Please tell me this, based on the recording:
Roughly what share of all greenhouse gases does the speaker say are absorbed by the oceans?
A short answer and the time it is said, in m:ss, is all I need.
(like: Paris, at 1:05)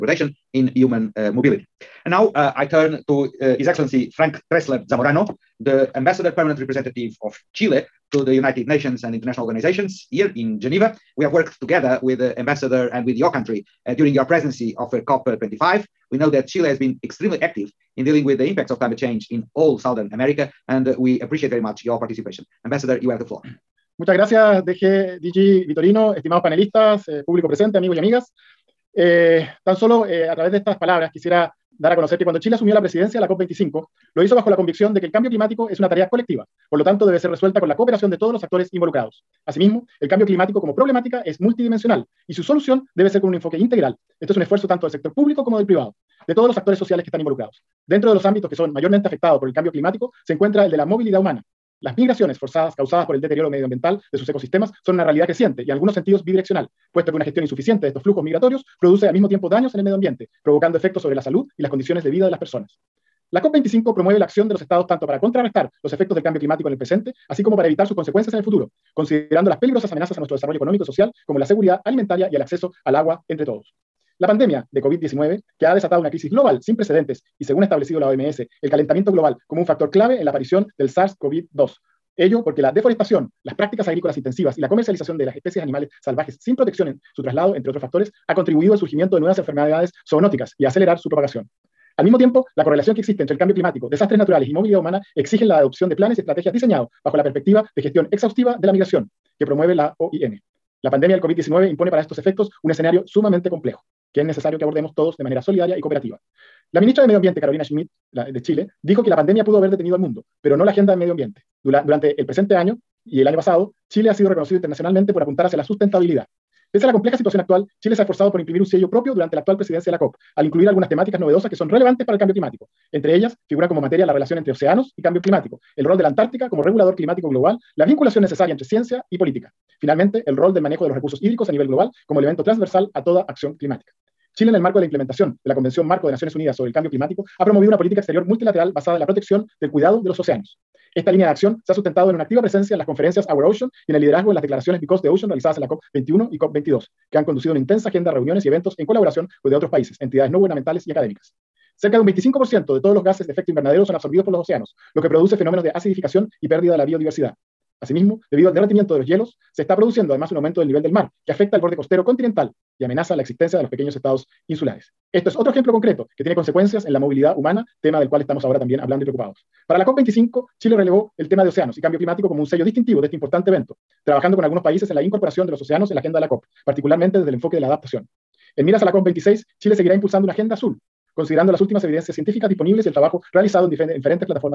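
25%, at 2:32.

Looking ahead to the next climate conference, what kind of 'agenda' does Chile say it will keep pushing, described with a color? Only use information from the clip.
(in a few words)
agenda azul.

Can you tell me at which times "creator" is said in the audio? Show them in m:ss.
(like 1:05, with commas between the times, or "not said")
not said.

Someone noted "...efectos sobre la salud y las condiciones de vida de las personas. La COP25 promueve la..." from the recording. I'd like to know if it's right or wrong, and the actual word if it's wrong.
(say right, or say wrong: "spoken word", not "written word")
right.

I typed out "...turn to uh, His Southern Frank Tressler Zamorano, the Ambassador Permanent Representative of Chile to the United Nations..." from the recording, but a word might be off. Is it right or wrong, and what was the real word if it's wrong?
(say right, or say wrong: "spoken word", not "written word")
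wrong: "Excellency", not "Southern".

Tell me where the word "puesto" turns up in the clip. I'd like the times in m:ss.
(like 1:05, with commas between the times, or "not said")
0:56.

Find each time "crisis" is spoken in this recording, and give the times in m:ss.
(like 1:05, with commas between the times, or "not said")
1:16.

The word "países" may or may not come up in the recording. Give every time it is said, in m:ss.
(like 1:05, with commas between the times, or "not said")
2:29, 2:54.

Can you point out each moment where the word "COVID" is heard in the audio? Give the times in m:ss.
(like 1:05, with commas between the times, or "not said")
1:14, 1:41.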